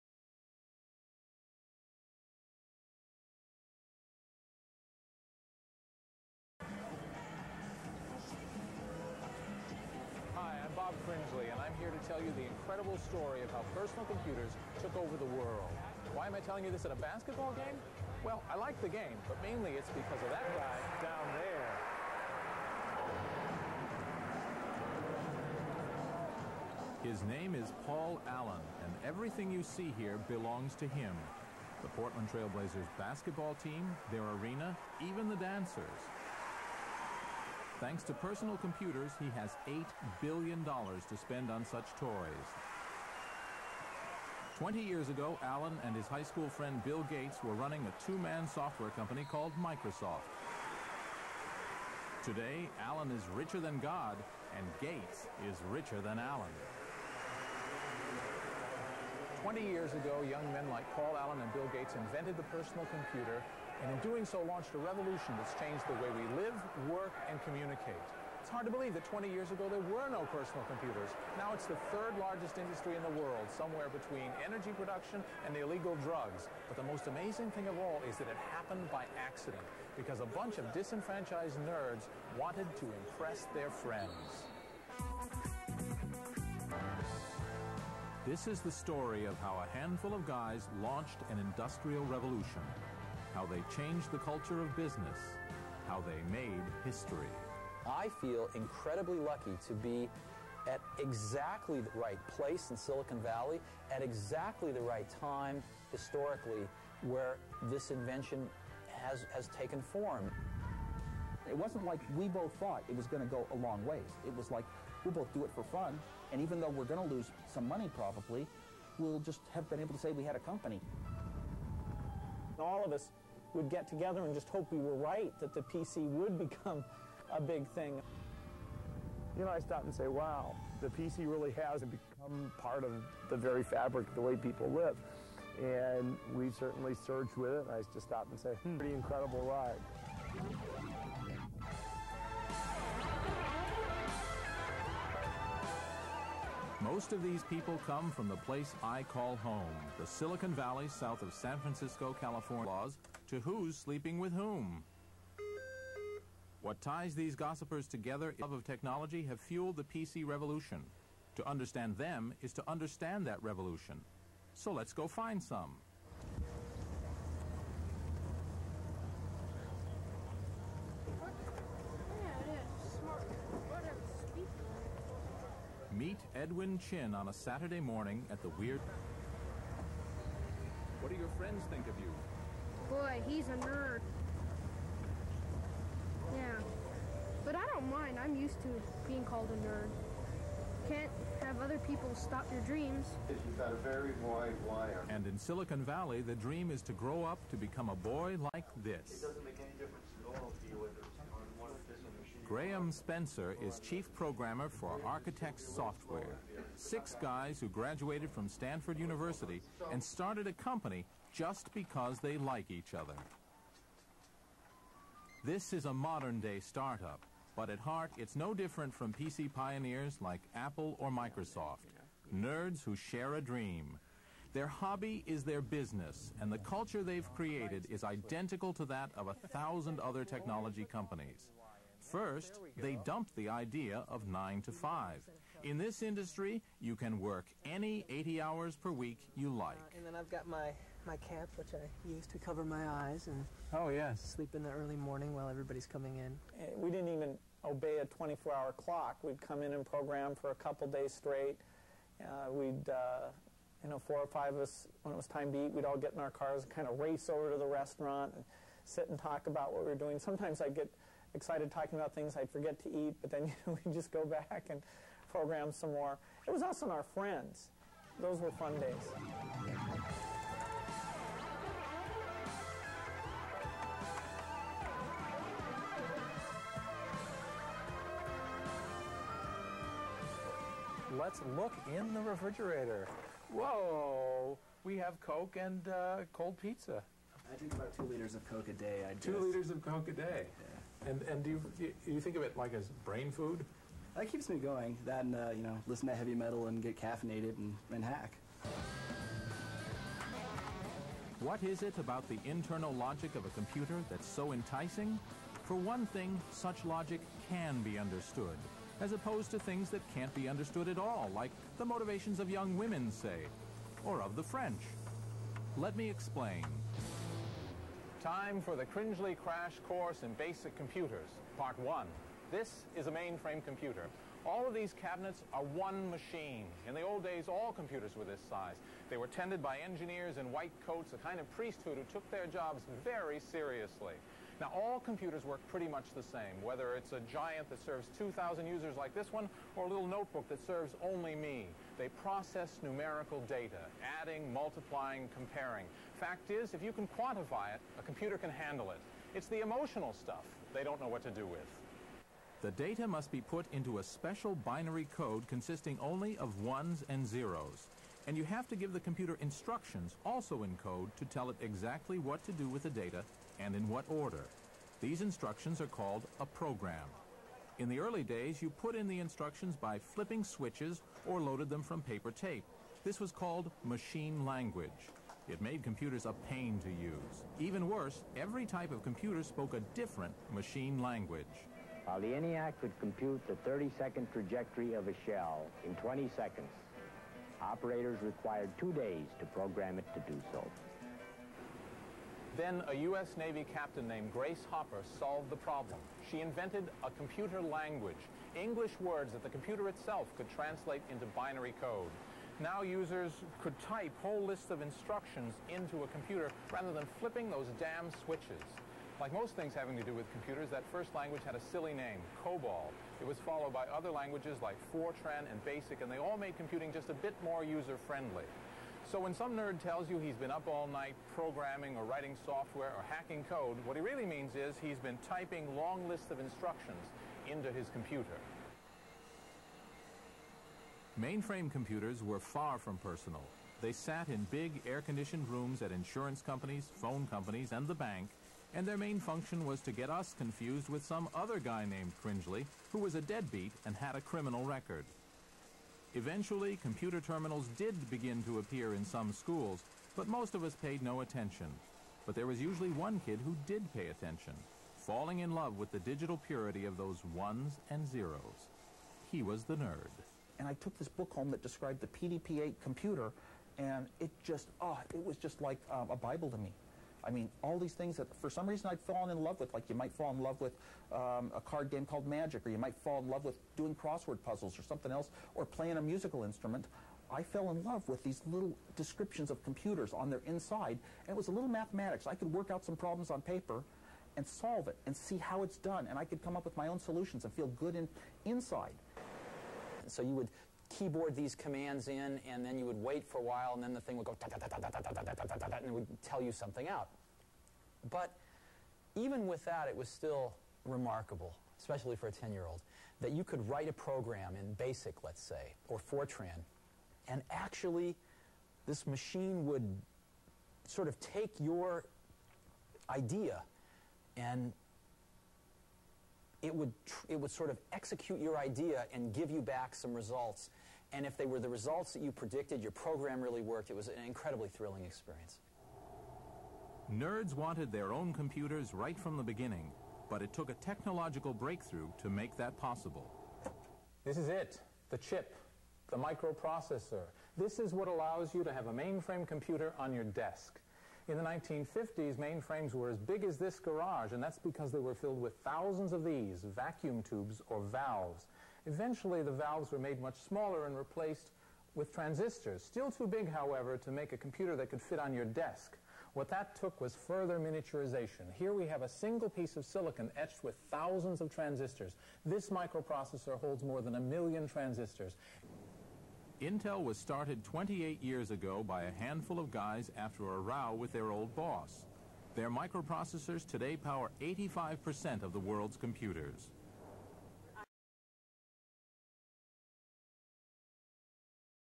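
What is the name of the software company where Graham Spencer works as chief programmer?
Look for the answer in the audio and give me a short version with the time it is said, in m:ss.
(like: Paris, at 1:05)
Architext Software, at 3:25.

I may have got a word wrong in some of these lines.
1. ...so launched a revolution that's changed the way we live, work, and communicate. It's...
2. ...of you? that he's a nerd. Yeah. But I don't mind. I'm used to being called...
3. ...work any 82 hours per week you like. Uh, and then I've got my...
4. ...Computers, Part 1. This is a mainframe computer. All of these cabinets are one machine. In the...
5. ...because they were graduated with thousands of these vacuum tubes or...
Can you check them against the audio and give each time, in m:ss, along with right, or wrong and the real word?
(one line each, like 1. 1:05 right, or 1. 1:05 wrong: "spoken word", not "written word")
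1. 1:04 right
2. 3:01 right
3. 3:57 wrong: "80", not "82"
4. 5:20 right
5. 9:04 wrong: "filled", not "graduated".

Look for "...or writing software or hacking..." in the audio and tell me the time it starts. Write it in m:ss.
7:01.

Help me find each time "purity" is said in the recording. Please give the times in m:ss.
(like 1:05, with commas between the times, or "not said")
7:36.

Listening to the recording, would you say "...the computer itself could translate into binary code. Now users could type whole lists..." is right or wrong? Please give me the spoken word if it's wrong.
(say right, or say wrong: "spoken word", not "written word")
right.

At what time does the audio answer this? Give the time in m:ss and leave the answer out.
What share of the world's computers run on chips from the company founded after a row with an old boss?
9:34.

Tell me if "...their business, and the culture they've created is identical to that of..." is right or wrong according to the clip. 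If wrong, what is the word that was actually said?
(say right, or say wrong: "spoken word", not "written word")
right.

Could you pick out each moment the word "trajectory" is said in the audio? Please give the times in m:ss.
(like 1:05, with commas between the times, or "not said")
6:24.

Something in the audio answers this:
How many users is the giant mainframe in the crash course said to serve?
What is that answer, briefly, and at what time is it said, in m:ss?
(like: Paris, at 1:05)
2,000, at 5:38.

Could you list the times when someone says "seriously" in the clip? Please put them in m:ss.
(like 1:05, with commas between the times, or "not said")
5:33.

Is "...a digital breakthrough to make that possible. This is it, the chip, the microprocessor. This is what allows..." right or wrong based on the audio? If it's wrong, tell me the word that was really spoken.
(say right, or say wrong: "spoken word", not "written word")
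wrong: "technological", not "digital".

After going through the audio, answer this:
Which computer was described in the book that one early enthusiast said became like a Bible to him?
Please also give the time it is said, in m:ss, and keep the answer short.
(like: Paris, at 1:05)
PDP-8, at 7:42.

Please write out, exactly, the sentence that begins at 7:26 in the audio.
Eventually, computer terminals did begin to appear in some schools, but most of us paid no attention.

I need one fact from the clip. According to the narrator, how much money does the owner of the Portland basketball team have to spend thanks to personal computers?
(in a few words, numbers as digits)
$8 billion.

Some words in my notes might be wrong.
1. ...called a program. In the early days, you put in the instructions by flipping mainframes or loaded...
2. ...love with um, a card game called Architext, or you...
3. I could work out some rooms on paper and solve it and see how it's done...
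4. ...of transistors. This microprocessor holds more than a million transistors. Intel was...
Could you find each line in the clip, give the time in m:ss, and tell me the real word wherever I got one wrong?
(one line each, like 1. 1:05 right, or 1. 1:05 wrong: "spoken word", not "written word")
1. 6:05 wrong: "switches", not "mainframes"
2. 7:50 wrong: "Magic", not "Architext"
3. 8:02 wrong: "problems", not "rooms"
4. 9:21 right.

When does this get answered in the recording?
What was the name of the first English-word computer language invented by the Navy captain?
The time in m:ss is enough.
6:52.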